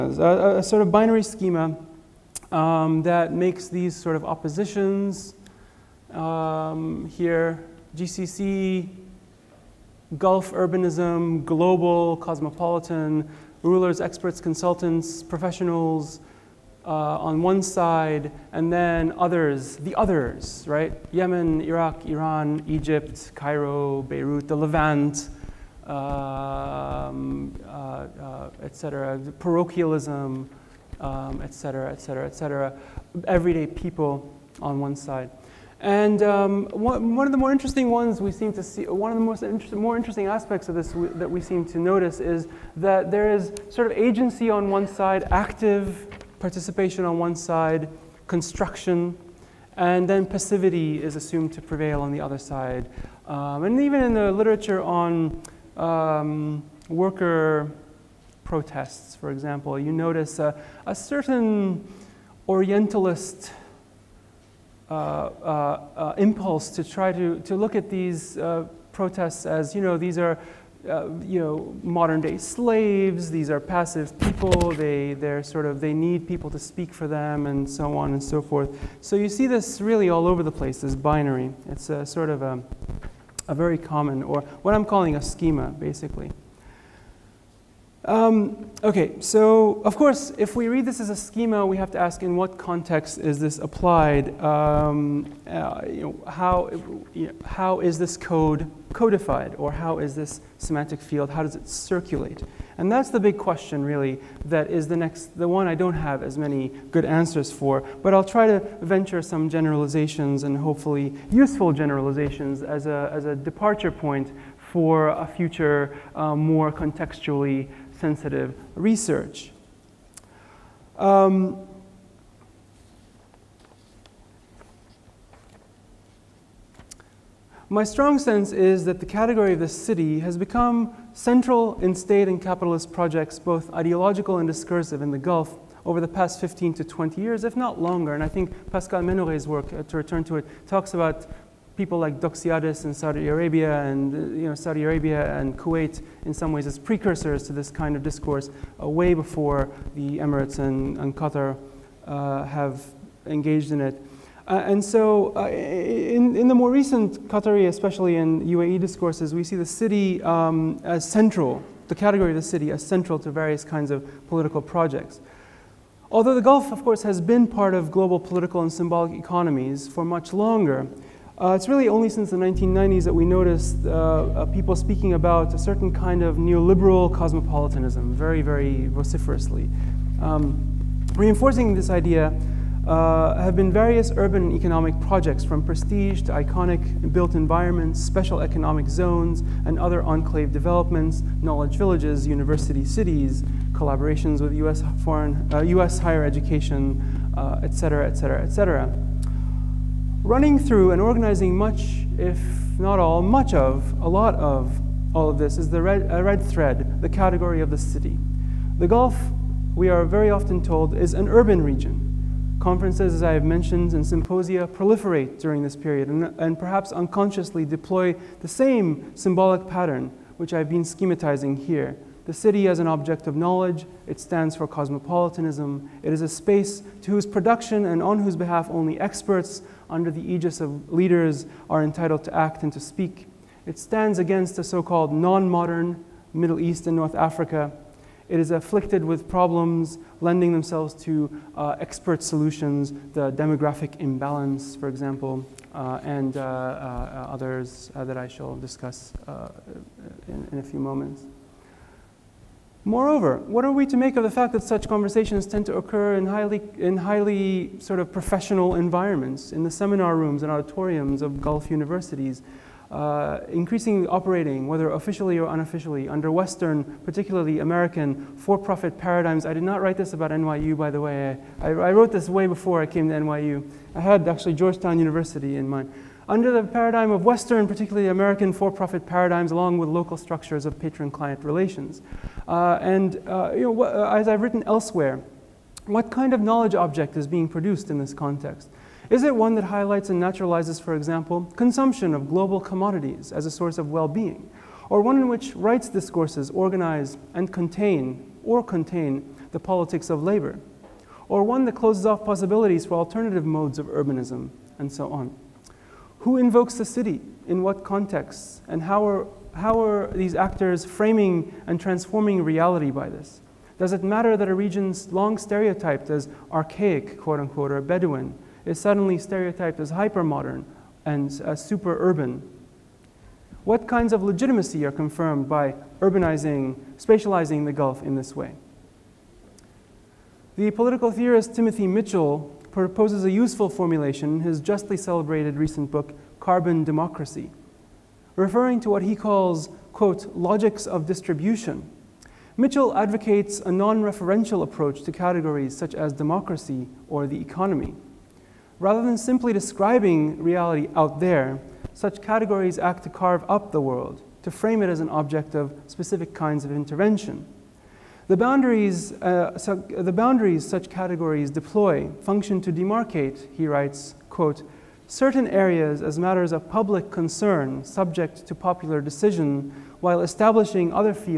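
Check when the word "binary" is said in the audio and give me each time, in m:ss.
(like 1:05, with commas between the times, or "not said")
0:00, 1:20.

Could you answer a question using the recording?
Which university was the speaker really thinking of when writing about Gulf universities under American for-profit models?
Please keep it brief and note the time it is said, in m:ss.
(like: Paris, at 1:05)
Georgetown University, at 4:34.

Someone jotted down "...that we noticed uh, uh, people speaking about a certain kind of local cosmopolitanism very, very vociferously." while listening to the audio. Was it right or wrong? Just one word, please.
wrong.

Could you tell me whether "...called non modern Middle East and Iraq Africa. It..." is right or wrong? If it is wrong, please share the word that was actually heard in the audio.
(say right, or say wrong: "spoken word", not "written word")
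wrong: "North", not "Iraq".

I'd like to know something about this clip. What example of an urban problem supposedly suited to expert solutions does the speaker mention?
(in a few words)
demographic imbalance.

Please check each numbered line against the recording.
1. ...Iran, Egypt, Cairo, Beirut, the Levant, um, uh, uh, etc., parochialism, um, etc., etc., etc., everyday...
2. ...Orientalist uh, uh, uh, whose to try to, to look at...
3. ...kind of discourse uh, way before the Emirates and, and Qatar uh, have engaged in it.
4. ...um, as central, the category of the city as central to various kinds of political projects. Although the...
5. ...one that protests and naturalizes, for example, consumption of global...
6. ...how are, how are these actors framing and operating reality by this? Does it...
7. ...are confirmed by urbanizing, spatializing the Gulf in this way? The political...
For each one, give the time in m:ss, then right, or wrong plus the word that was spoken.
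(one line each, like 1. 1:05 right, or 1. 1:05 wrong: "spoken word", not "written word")
1. 0:22 right
2. 1:02 wrong: "impulse", not "whose"
3. 2:27 right
4. 2:40 right
5. 4:49 wrong: "highlights", not "protests"
6. 5:08 wrong: "transforming", not "operating"
7. 5:24 right.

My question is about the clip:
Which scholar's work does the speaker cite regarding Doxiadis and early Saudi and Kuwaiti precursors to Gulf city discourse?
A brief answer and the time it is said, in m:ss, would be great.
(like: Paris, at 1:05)
Pascal Menoret, at 2:18.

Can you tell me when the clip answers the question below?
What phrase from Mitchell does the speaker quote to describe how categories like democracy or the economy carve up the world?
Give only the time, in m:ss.
5:40.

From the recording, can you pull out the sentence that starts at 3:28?
The Gulf, we are very often told, is an urban region.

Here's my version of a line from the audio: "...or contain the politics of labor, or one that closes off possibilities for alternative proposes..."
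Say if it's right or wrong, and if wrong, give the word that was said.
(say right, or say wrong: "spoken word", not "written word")
wrong: "modes", not "proposes".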